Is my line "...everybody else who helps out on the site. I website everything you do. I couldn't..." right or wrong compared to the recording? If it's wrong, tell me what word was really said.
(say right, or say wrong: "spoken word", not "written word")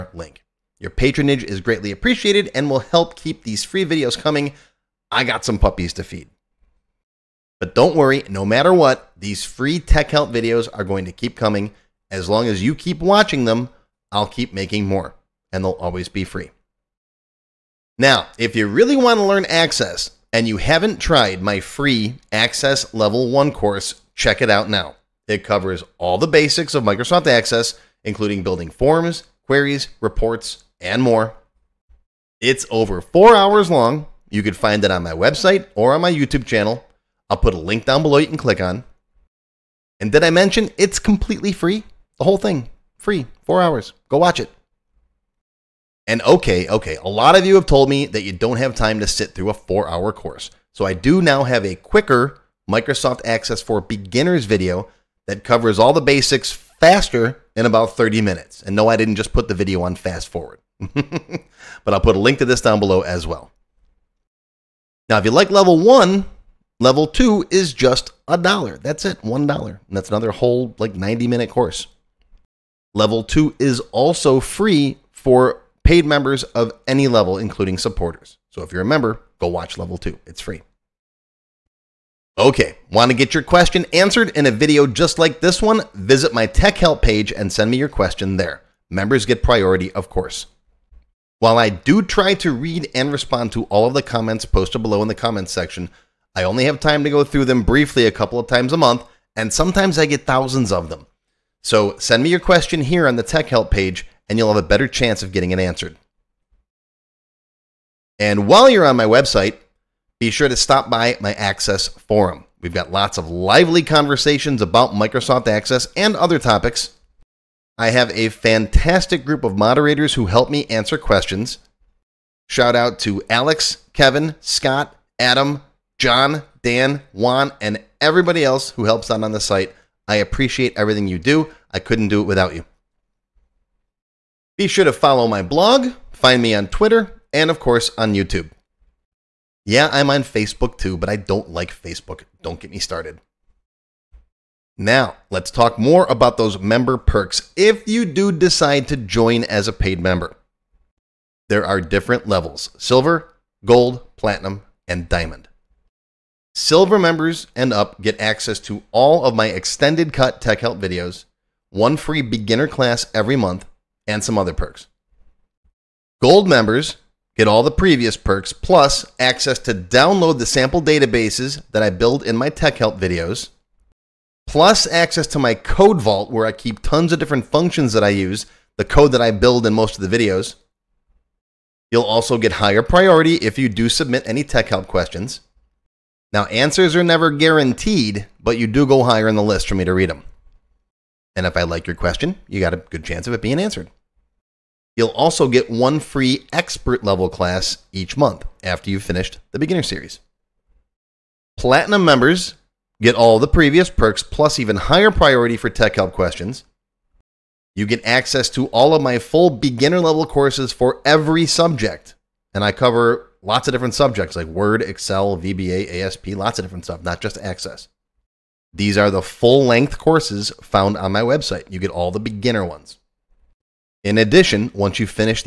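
wrong: "appreciate", not "website".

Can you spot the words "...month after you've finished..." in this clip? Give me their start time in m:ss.
3:18.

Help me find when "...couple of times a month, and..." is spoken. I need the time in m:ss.
1:38.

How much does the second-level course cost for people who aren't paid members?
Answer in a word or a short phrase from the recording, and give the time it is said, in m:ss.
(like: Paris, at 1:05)
1 dollar, at 1:09.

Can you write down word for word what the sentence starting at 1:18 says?
So if you're a member, go watch level two.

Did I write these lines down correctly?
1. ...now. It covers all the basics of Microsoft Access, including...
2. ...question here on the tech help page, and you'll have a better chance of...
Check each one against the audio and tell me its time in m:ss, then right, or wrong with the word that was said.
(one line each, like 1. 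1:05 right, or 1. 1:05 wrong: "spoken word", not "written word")
1. 0:24 right
2. 1:42 right.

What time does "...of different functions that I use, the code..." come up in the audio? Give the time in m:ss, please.
2:57.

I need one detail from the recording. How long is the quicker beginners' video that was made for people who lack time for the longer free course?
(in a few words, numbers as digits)
30 minutes.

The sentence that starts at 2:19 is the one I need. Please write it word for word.
Yeah, I'm on Facebook too, but I don't like Facebook.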